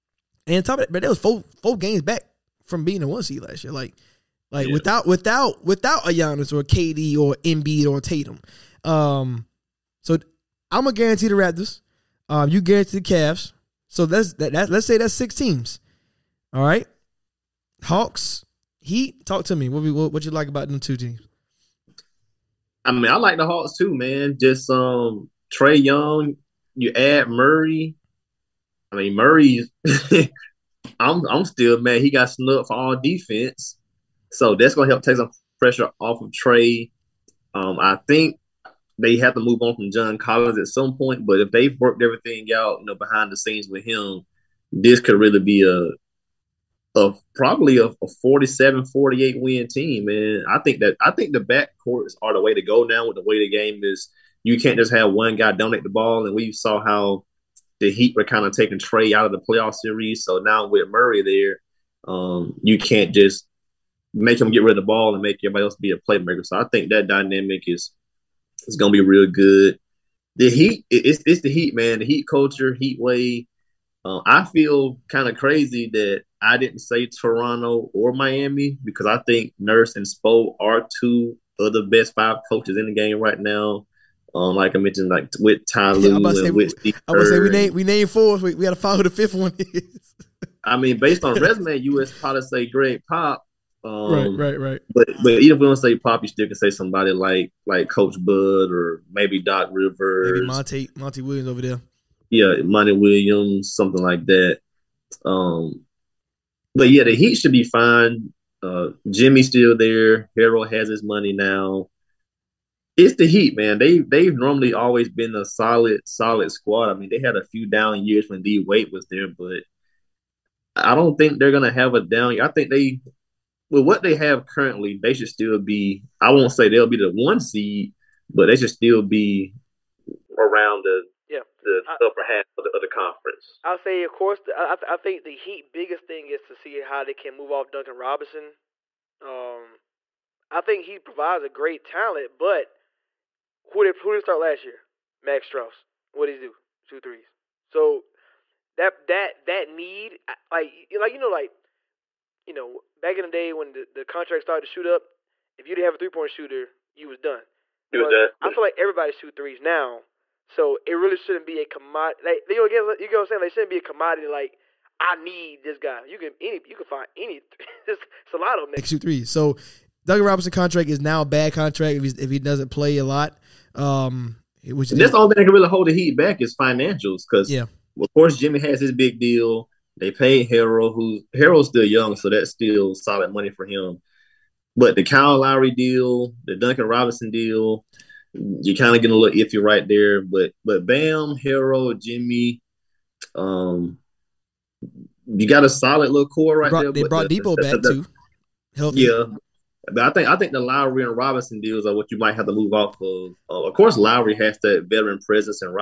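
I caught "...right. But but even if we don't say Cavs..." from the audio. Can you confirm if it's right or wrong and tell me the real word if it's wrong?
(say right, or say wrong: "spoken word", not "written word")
wrong: "Pop", not "Cavs".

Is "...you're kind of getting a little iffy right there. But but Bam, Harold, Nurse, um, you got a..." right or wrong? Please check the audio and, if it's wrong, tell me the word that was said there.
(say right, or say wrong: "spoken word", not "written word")
wrong: "Jimmy", not "Nurse".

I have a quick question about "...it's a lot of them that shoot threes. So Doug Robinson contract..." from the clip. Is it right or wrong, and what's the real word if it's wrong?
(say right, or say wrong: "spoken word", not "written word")
right.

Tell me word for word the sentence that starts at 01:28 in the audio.
We, we got to follow the fifth one is.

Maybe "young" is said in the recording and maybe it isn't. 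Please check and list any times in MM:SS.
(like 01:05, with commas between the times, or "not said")
00:25, 03:01.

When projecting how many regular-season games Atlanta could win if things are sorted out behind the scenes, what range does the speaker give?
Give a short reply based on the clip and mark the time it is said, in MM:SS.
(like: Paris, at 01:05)
47-48, at 00:48.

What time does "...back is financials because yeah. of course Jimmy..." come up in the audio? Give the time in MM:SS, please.
02:56.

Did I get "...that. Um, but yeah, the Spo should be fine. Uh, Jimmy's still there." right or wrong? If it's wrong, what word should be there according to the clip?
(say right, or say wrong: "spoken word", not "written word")
wrong: "Heat", not "Spo".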